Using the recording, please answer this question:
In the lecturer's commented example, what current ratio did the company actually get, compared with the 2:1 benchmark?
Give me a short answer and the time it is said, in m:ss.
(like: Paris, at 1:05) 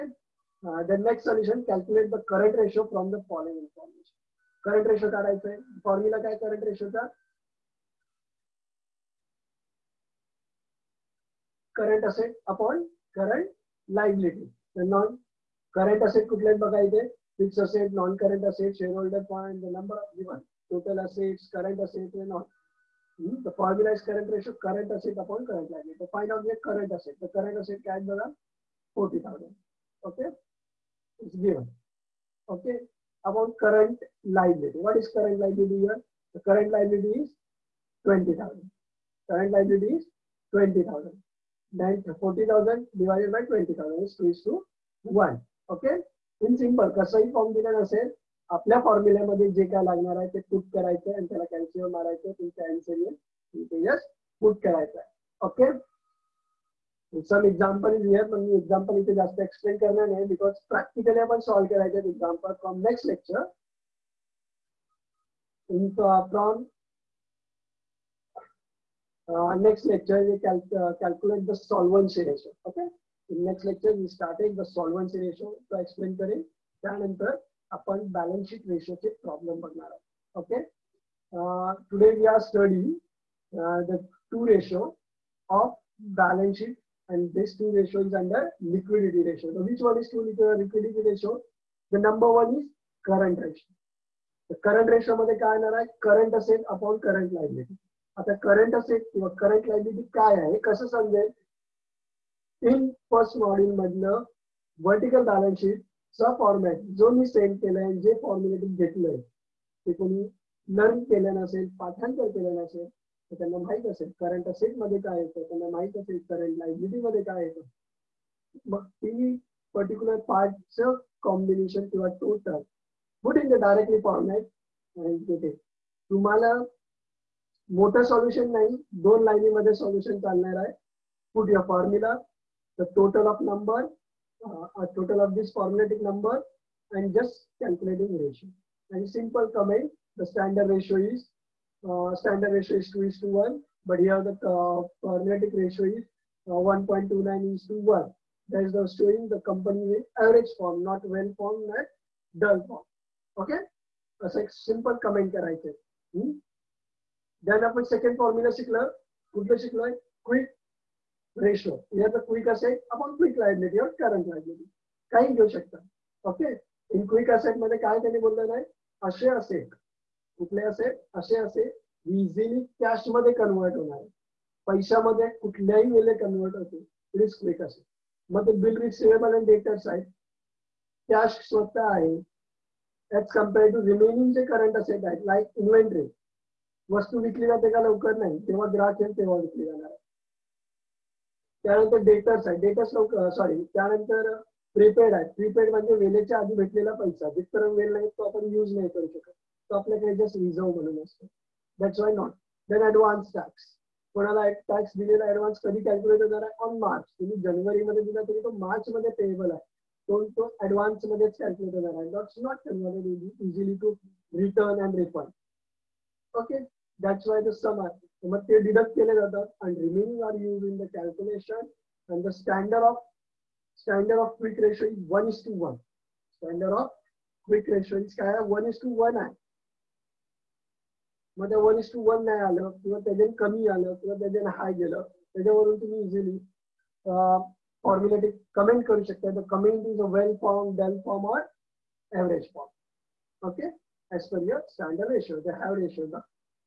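1.29:1, at 2:26.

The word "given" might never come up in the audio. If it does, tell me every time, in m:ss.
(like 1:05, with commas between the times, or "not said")
0:20, 0:31.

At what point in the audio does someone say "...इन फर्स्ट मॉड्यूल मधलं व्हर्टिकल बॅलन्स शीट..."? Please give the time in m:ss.
1:42.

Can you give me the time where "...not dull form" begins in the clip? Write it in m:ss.
2:31.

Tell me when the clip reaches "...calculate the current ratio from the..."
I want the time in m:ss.
0:01.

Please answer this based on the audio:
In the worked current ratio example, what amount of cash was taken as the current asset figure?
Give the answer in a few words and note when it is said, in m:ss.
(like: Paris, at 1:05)
40,000, at 0:28.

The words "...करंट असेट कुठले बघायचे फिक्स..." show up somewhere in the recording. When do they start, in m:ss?
0:15.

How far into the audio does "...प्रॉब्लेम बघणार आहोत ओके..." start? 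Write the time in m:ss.
1:19.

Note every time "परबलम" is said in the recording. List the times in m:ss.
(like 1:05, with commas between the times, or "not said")
1:19.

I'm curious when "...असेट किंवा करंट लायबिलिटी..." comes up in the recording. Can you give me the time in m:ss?
1:38.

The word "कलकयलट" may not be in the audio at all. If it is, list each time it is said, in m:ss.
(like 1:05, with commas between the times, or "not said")
1:10, 3:25, 3:31.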